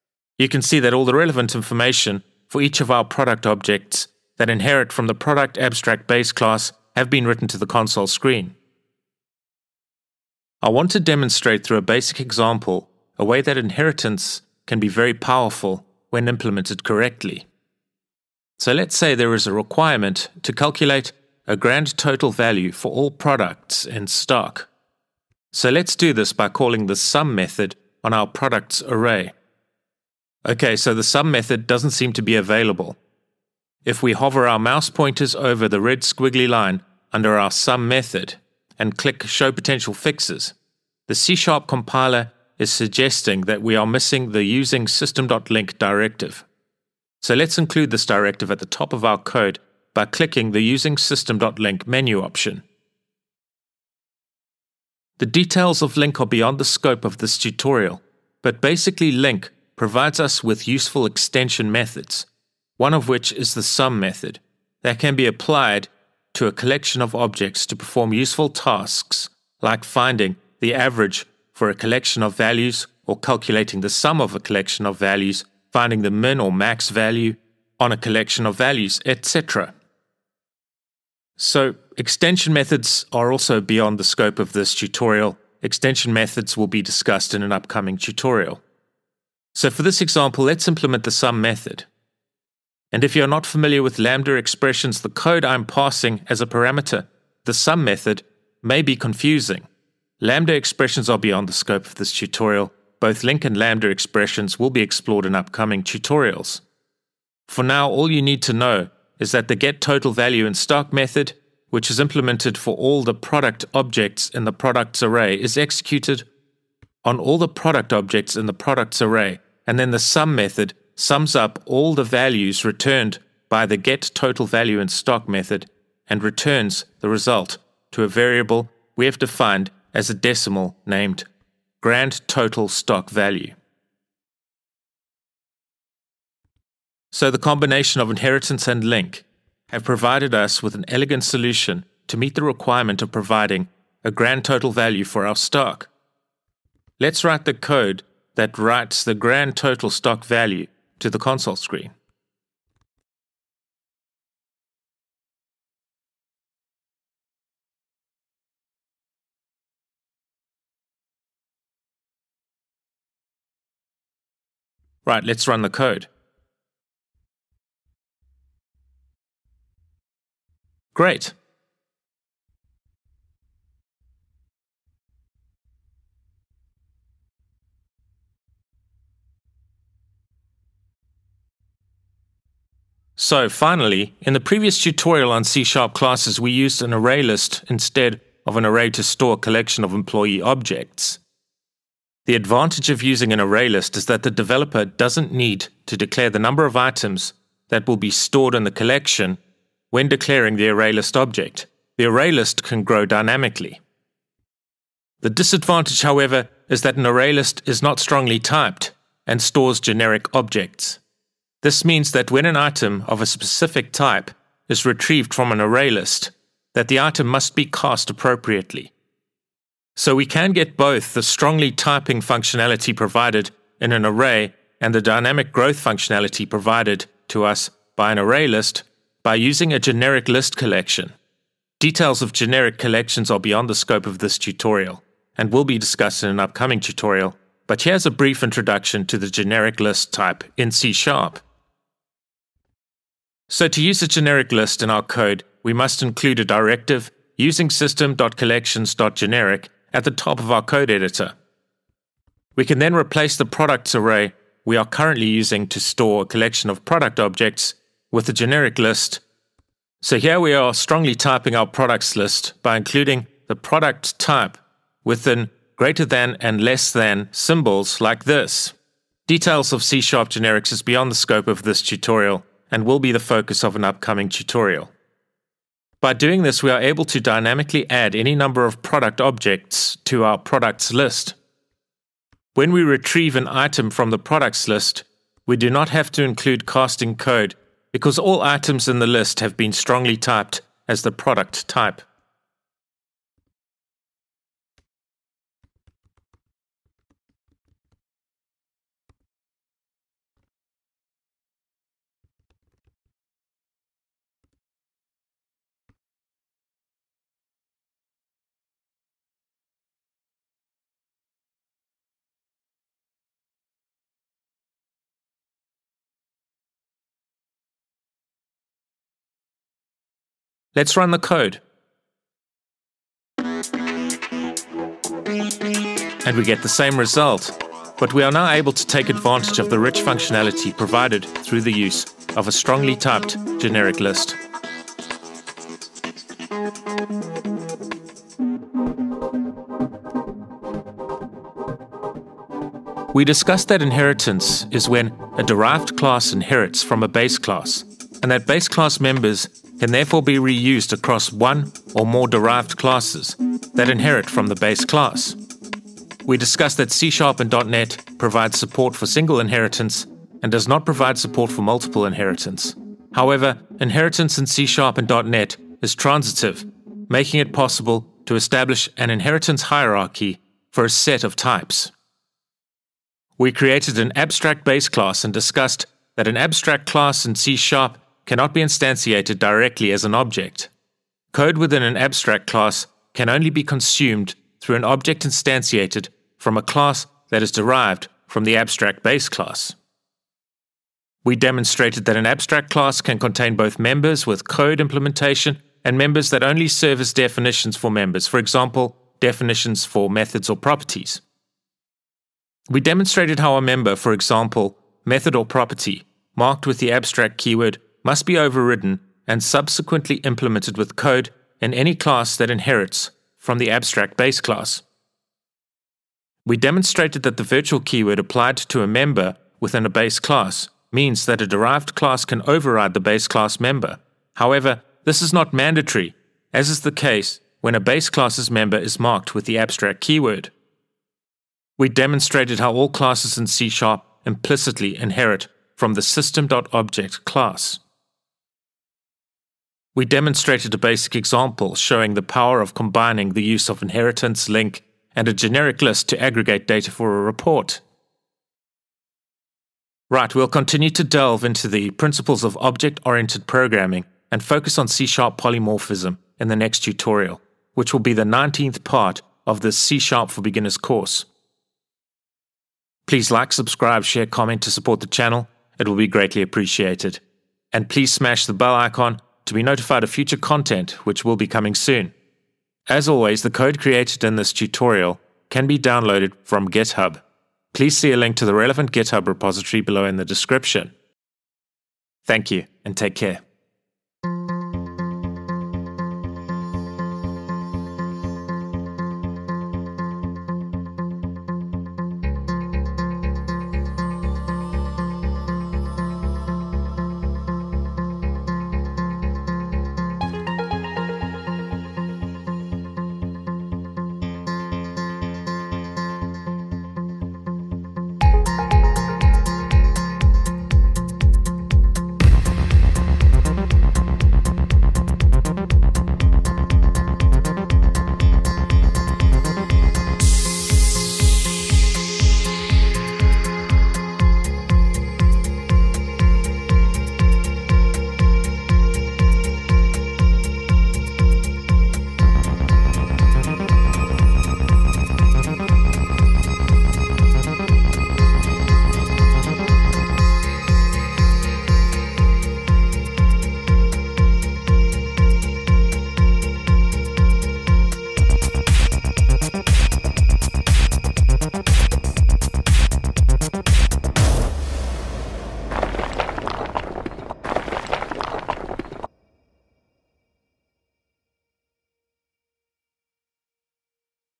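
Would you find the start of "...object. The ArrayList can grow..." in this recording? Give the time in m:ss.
3:21.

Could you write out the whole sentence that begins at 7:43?
Please like, subscribe, share, comment to support the channel.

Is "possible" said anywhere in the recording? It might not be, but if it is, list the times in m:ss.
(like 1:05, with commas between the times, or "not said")
6:07.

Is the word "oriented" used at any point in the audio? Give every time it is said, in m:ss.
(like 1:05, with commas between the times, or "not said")
7:33.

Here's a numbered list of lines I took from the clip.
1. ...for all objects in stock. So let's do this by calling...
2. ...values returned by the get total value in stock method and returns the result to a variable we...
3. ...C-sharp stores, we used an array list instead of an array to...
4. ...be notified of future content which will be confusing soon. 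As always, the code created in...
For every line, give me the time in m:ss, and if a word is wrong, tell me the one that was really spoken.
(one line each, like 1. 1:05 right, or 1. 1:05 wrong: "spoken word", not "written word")
1. 0:22 wrong: "products", not "objects"
2. 2:02 right
3. 3:05 wrong: "classes", not "stores"
4. 7:49 wrong: "coming", not "confusing".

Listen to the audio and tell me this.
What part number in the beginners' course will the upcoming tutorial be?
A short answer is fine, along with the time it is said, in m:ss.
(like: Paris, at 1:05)
19, at 7:38.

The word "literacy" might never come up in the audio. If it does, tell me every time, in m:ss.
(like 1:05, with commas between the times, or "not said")
not said.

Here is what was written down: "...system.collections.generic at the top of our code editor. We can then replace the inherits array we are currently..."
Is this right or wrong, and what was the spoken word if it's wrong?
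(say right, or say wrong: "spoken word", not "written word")
wrong: "products", not "inherits".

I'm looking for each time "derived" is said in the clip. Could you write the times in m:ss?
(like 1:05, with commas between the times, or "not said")
5:45, 5:52, 6:27, 7:01.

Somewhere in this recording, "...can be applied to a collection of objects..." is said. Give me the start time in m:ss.
1:04.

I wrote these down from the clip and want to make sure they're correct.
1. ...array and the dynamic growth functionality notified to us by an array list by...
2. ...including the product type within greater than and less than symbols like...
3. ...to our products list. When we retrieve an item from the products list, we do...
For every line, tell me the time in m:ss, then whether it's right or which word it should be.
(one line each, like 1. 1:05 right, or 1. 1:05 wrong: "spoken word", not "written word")
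1. 3:44 wrong: "provided", not "notified"
2. 4:22 right
3. 4:40 right.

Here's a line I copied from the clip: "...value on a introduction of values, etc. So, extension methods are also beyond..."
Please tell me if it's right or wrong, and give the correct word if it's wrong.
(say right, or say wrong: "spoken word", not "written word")
wrong: "collection", not "introduction".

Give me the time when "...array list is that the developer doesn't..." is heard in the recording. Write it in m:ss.
3:13.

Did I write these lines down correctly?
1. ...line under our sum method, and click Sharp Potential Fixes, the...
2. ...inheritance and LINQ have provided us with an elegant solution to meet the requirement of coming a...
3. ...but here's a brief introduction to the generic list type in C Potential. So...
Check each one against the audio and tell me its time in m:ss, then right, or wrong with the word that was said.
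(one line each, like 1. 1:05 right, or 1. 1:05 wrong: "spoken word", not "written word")
1. 0:36 wrong: "Show", not "Sharp"
2. 2:18 wrong: "providing", not "coming"
3. 3:57 wrong: "Sharp", not "Potential".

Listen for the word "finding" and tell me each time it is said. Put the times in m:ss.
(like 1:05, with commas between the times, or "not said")
1:09, 1:15.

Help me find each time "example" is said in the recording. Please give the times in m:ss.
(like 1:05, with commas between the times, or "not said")
0:12, 1:29, 6:38, 6:44, 7:21.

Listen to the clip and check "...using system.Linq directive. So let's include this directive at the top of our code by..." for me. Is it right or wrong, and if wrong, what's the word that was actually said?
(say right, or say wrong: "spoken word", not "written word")
right.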